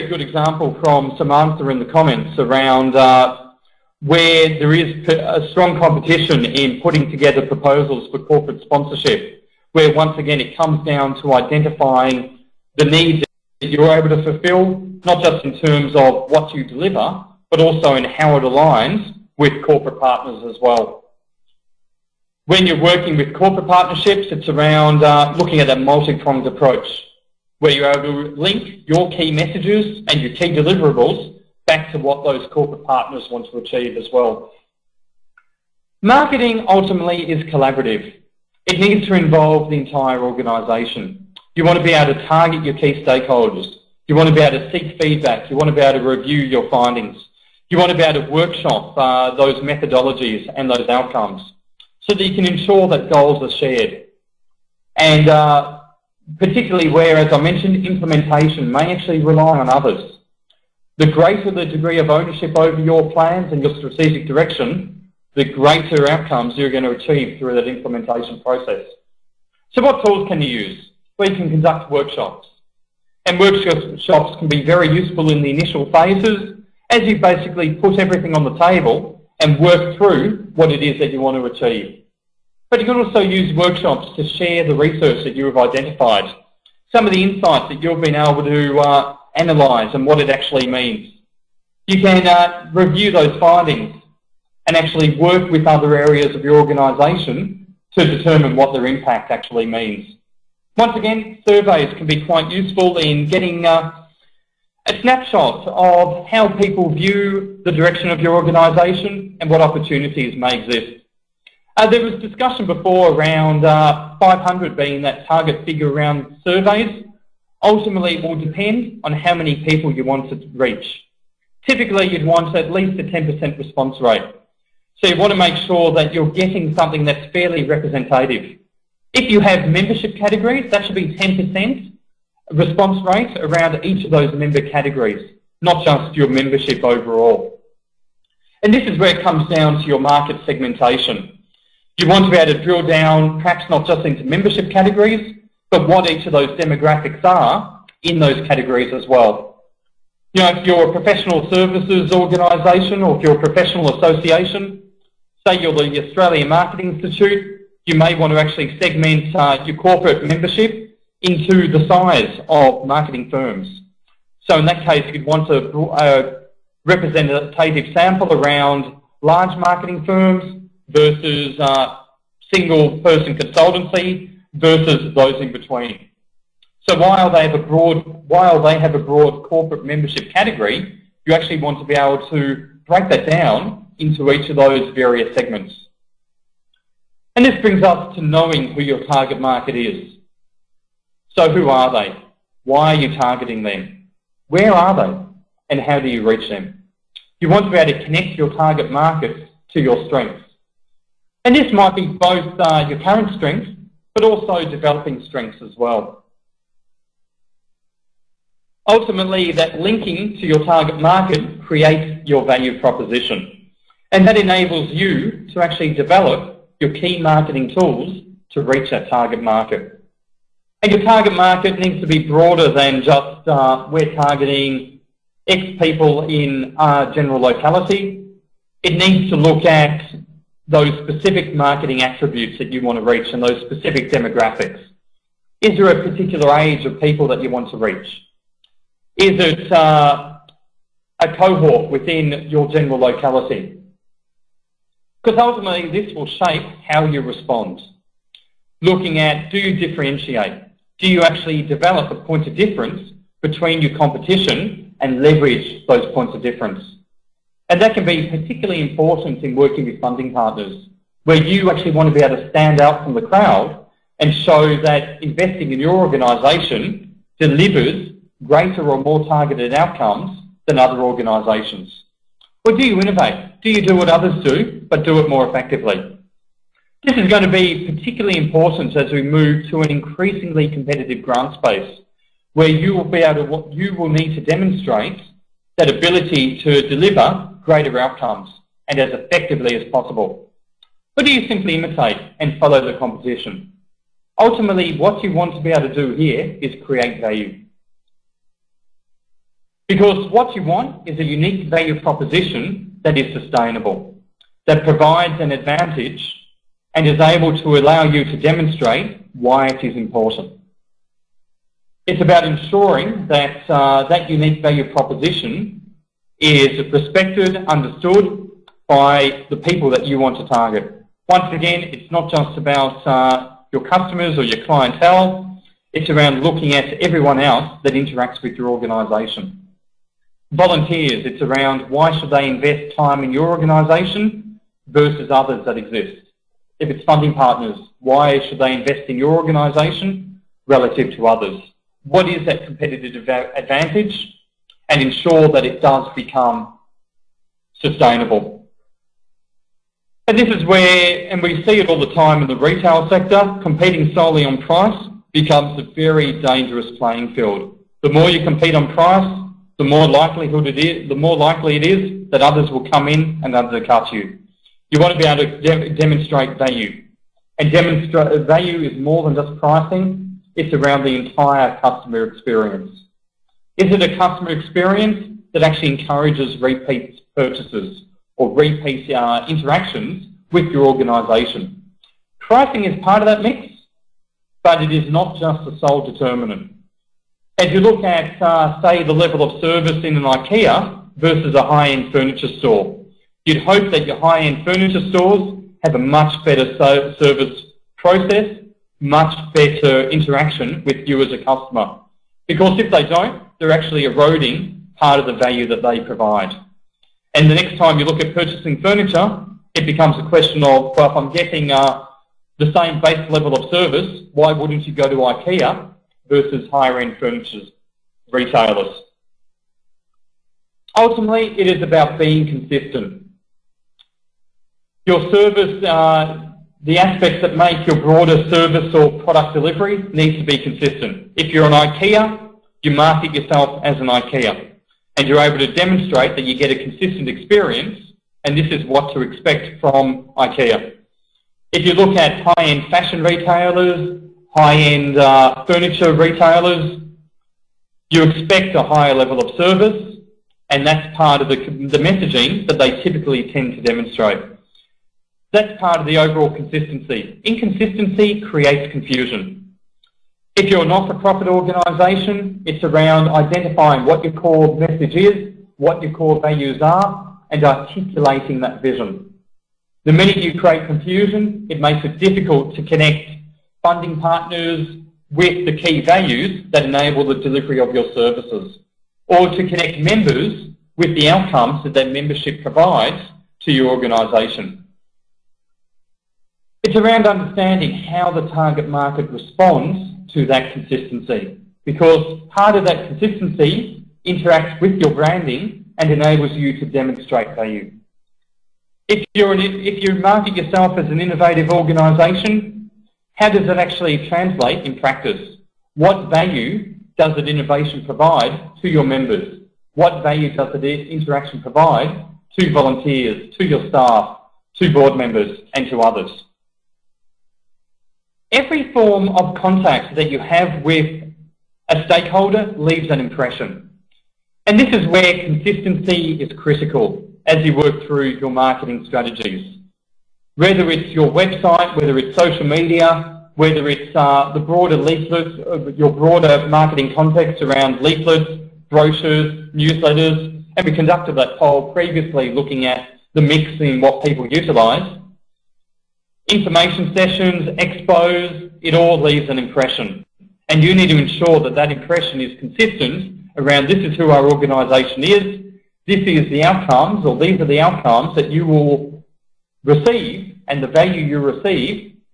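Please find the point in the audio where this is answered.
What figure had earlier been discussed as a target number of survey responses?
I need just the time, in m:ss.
1:54.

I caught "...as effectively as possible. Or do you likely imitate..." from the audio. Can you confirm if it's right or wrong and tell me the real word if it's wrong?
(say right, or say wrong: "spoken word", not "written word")
wrong: "simply", not "likely".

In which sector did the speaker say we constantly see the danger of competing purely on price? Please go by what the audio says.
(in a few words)
retail sector.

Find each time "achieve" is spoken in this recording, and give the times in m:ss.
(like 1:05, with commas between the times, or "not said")
0:33, 1:06, 1:21.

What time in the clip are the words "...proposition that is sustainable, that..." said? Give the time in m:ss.
5:01.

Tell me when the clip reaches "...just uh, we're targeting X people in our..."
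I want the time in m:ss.
3:43.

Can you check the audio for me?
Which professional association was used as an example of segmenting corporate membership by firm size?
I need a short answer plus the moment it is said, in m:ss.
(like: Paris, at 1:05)
Australian Marketing Institute, at 2:36.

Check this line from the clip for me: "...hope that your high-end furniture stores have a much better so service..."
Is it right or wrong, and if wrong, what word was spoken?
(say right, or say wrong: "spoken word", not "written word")
right.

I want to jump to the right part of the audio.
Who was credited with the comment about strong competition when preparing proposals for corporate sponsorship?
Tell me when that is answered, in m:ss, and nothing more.
0:01.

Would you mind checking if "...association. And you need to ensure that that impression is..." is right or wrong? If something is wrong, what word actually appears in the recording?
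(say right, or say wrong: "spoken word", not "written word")
wrong: "impression", not "association".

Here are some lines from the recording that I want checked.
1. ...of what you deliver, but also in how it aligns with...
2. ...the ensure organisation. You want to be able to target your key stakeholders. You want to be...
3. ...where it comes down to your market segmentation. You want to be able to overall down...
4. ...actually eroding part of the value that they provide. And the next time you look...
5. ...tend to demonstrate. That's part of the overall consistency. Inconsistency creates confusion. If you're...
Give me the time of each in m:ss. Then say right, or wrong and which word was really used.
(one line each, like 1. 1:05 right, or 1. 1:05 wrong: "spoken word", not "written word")
1. 0:15 right
2. 0:39 wrong: "entire", not "ensure"
3. 2:18 wrong: "drill", not "overall"
4. 6:43 right
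5. 7:33 right.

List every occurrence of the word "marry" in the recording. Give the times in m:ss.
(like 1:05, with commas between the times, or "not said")
not said.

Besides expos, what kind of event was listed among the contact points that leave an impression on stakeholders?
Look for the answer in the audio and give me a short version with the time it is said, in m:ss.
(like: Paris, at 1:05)
Information sessions, at 9:06.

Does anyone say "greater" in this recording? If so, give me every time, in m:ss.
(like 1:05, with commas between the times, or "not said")
1:01, 1:05, 4:28, 4:47.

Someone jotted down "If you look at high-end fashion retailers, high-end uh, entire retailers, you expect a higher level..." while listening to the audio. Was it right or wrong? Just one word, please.
wrong.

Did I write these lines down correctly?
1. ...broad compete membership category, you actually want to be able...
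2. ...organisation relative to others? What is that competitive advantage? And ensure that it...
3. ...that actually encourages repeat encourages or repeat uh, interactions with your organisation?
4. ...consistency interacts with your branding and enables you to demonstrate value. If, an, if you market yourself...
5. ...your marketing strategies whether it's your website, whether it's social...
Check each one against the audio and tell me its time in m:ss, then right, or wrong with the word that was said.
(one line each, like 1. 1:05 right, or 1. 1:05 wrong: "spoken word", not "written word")
1. 2:58 wrong: "corporate", not "compete"
2. 5:39 right
3. 6:15 wrong: "purchases", not "encourages"
4. 8:13 right
5. 8:48 right.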